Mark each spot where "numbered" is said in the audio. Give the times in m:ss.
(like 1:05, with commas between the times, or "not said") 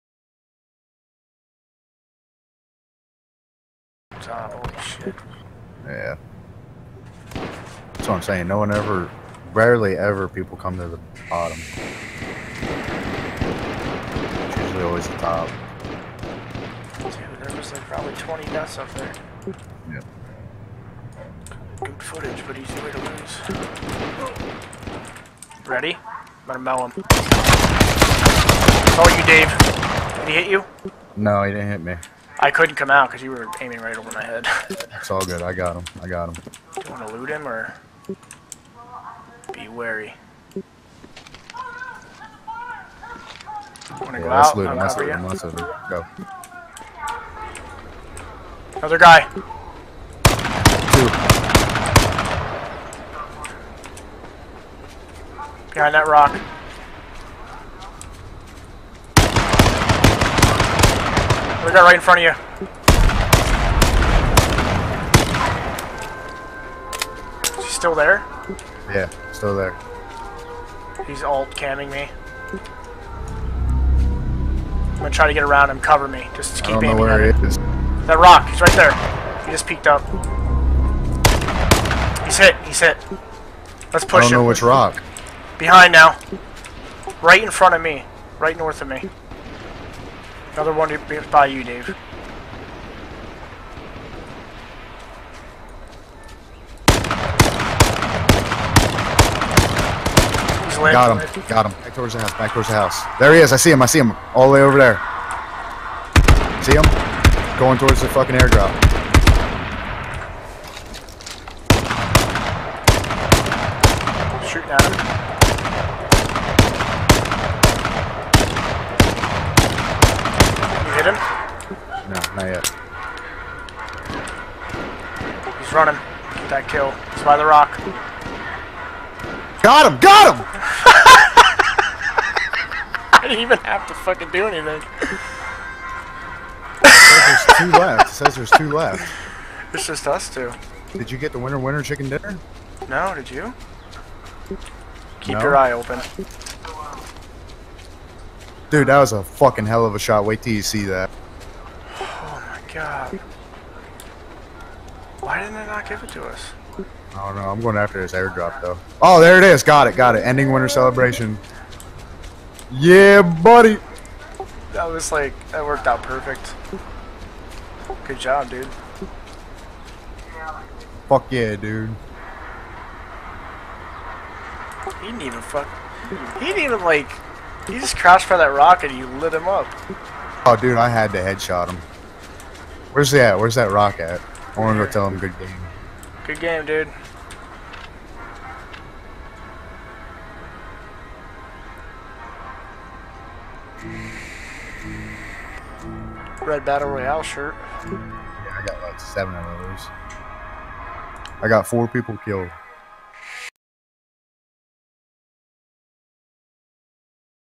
not said.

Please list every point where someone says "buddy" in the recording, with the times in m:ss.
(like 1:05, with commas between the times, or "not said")
2:43.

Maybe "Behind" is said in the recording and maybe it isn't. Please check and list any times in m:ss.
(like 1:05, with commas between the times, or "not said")
0:55, 1:25.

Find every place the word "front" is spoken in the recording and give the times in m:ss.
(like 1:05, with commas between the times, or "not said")
1:02, 1:27.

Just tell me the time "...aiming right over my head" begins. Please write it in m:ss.
0:33.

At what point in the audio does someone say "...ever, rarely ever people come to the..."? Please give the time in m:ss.
0:08.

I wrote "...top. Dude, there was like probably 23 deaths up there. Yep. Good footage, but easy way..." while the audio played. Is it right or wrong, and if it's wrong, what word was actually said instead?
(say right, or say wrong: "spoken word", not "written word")
wrong: "20", not "23".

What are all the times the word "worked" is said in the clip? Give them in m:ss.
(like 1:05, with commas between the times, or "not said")
2:45.